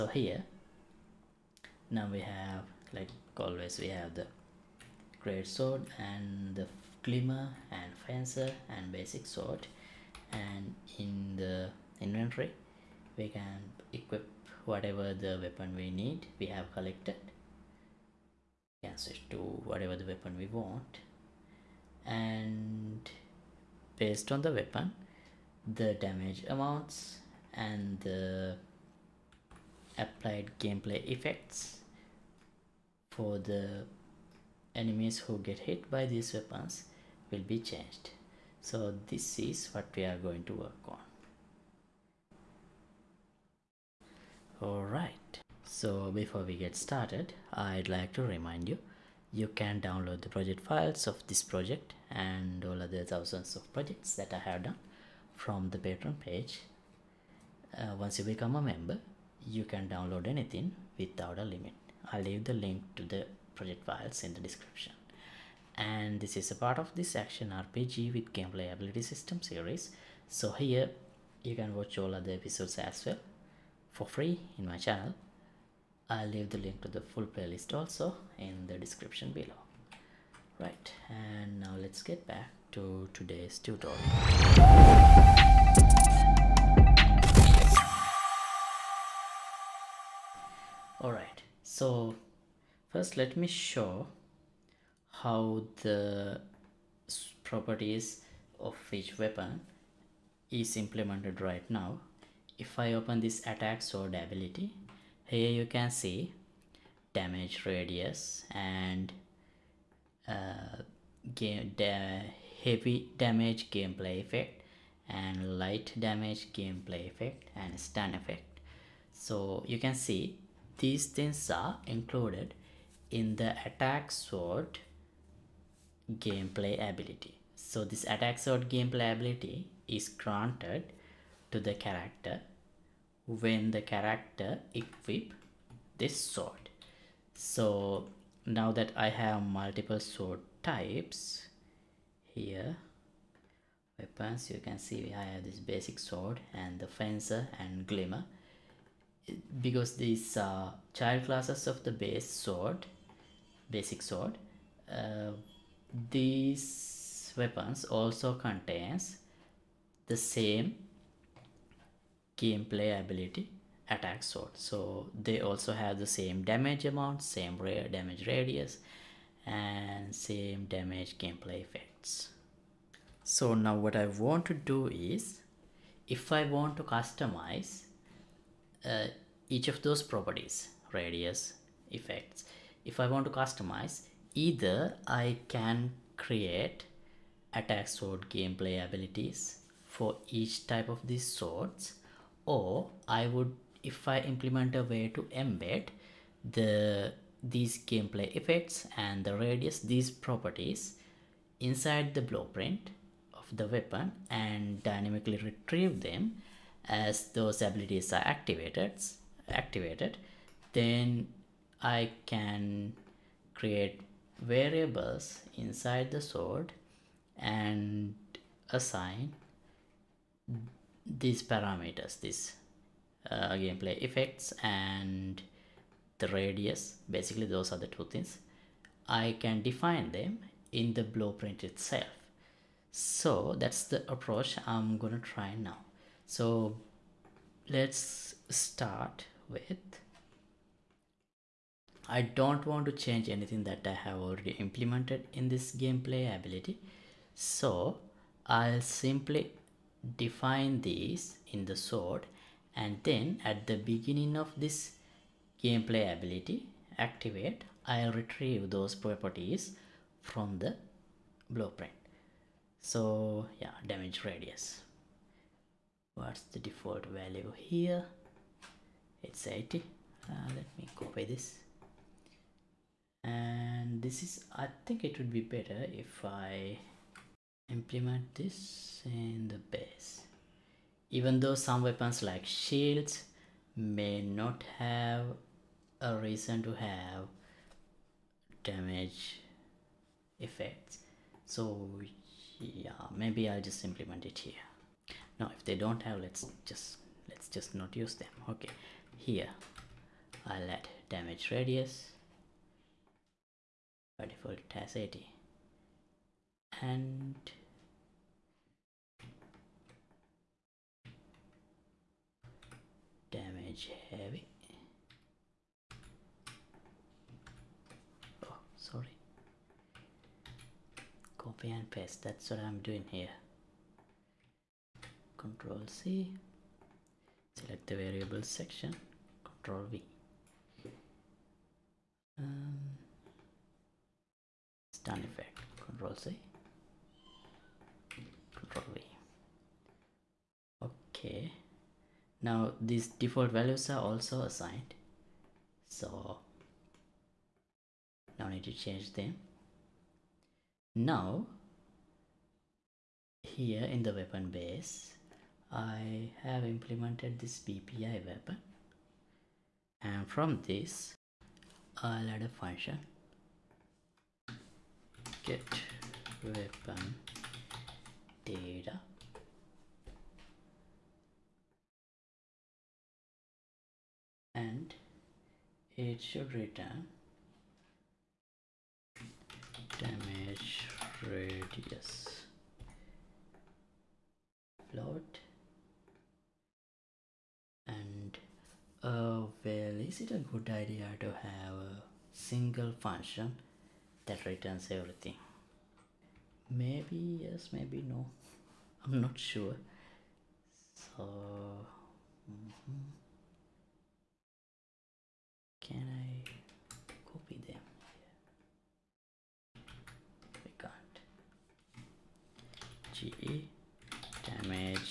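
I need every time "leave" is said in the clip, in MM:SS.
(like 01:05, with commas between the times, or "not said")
01:02, 01:16.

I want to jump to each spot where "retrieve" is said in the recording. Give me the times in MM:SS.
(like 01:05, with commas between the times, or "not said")
03:25, 04:18.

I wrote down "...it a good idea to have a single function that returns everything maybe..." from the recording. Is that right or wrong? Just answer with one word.
right.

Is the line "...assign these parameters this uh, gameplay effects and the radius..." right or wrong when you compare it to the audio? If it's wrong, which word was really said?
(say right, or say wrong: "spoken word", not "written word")
right.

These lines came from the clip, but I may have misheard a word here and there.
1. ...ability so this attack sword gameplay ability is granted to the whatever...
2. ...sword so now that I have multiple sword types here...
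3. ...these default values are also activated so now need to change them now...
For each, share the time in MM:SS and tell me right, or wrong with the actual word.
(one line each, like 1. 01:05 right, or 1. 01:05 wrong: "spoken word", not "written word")
1. 02:06 wrong: "character", not "whatever"
2. 02:16 right
3. 05:42 wrong: "assigned", not "activated".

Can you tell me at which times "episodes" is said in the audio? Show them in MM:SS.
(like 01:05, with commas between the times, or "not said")
01:12.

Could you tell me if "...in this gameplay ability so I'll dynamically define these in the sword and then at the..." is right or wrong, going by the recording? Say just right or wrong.
wrong.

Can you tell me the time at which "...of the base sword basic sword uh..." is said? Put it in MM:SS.
02:31.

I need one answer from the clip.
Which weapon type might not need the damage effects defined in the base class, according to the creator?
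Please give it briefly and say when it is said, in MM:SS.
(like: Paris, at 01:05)
shields, at 04:42.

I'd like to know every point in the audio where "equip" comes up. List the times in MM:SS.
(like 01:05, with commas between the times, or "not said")
00:13, 02:14.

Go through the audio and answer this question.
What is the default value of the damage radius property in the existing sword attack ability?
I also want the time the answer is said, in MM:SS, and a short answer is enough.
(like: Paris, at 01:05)
80, at 04:29.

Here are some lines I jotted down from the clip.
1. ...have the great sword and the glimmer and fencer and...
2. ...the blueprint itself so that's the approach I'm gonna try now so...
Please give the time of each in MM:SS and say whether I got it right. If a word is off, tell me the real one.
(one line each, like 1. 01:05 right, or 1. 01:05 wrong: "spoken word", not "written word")
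1. 00:03 right
2. 03:50 right.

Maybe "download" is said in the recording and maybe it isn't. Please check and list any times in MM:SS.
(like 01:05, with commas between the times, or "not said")
00:49, 00:59.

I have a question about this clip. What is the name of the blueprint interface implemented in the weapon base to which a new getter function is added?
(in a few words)
BPI weapon.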